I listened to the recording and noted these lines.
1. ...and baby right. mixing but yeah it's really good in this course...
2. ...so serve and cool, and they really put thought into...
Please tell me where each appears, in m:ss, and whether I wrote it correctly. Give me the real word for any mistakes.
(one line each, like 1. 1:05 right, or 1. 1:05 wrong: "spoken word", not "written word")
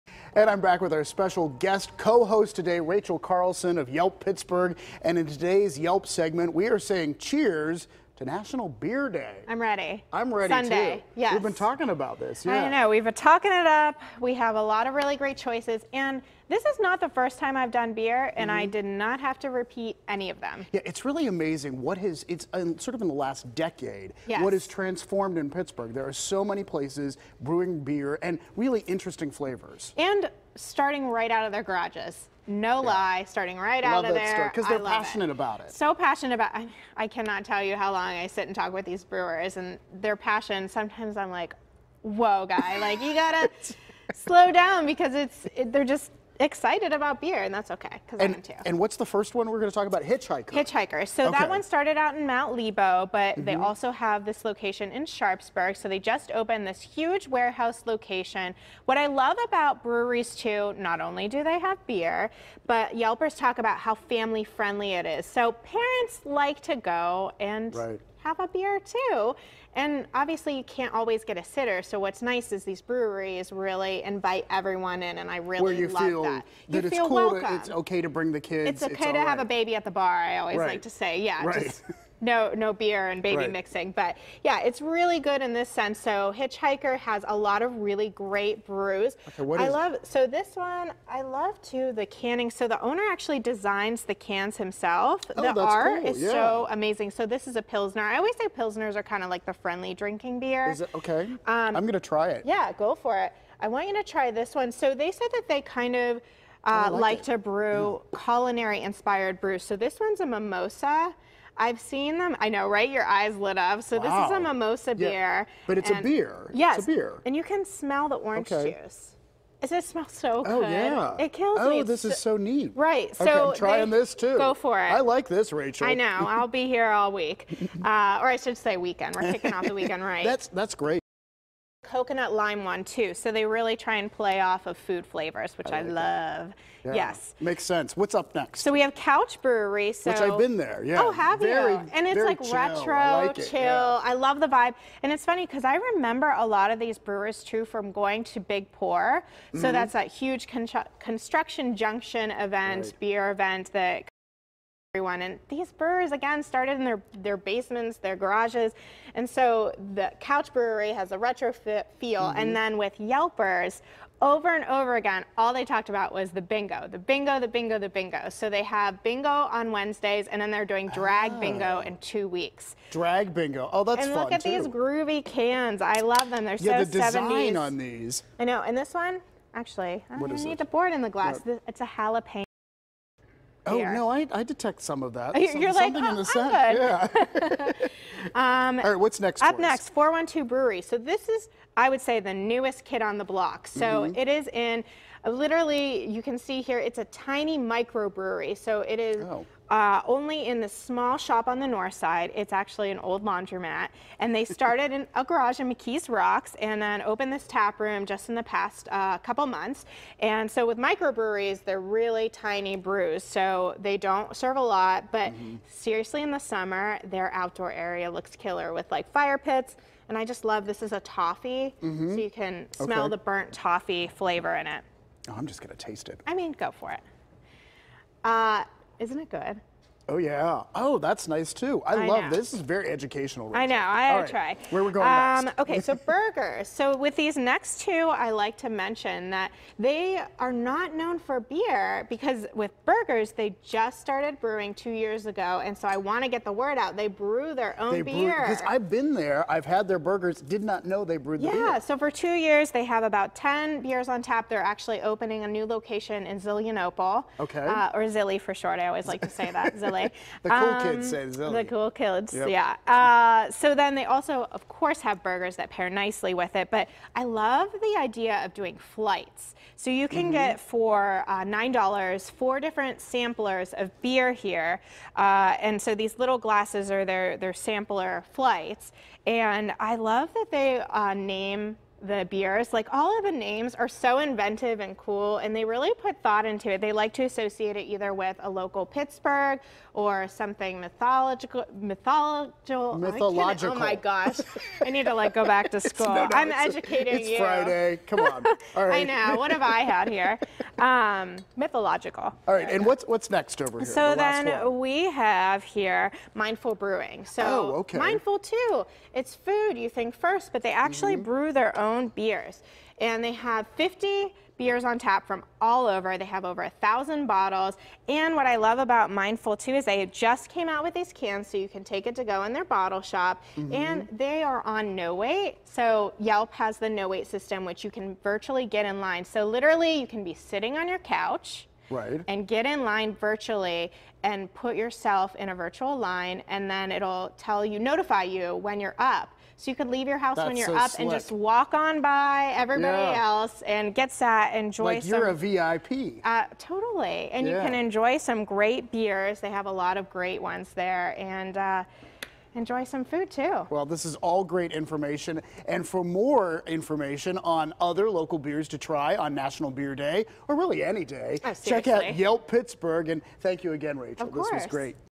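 1. 1:23 wrong: "sense", not "course"
2. 4:43 wrong: "inventive", not "serve".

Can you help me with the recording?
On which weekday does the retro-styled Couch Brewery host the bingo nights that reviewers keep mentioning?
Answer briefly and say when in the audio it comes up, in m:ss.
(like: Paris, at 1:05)
Wednesdays, at 2:49.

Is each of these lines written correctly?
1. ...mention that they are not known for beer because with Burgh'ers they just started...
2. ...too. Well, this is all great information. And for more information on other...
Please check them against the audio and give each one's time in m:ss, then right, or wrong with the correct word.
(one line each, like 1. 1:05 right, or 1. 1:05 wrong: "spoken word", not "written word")
1. 3:58 right
2. 5:53 right.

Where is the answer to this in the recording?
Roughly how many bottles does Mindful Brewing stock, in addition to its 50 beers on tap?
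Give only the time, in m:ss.
5:16.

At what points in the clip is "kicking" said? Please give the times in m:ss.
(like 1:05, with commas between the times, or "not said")
2:09.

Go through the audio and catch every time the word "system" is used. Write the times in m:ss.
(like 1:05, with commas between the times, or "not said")
5:27.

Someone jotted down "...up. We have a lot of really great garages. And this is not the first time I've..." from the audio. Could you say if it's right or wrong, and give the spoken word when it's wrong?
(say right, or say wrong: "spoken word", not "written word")
wrong: "choices", not "garages".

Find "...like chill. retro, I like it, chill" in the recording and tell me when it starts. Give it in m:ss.
2:22.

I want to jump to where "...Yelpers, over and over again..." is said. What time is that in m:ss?
2:43.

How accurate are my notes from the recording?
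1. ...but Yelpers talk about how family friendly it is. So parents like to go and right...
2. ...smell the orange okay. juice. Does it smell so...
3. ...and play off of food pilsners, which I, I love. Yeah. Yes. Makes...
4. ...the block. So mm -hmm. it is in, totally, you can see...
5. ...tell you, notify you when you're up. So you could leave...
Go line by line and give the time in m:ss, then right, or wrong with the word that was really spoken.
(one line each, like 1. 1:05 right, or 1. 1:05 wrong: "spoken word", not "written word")
1. 1:02 right
2. 1:57 right
3. 2:13 wrong: "flavors", not "pilsners"
4. 3:13 wrong: "literally", not "totally"
5. 5:37 right.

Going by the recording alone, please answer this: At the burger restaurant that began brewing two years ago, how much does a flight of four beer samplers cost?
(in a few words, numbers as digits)
$9.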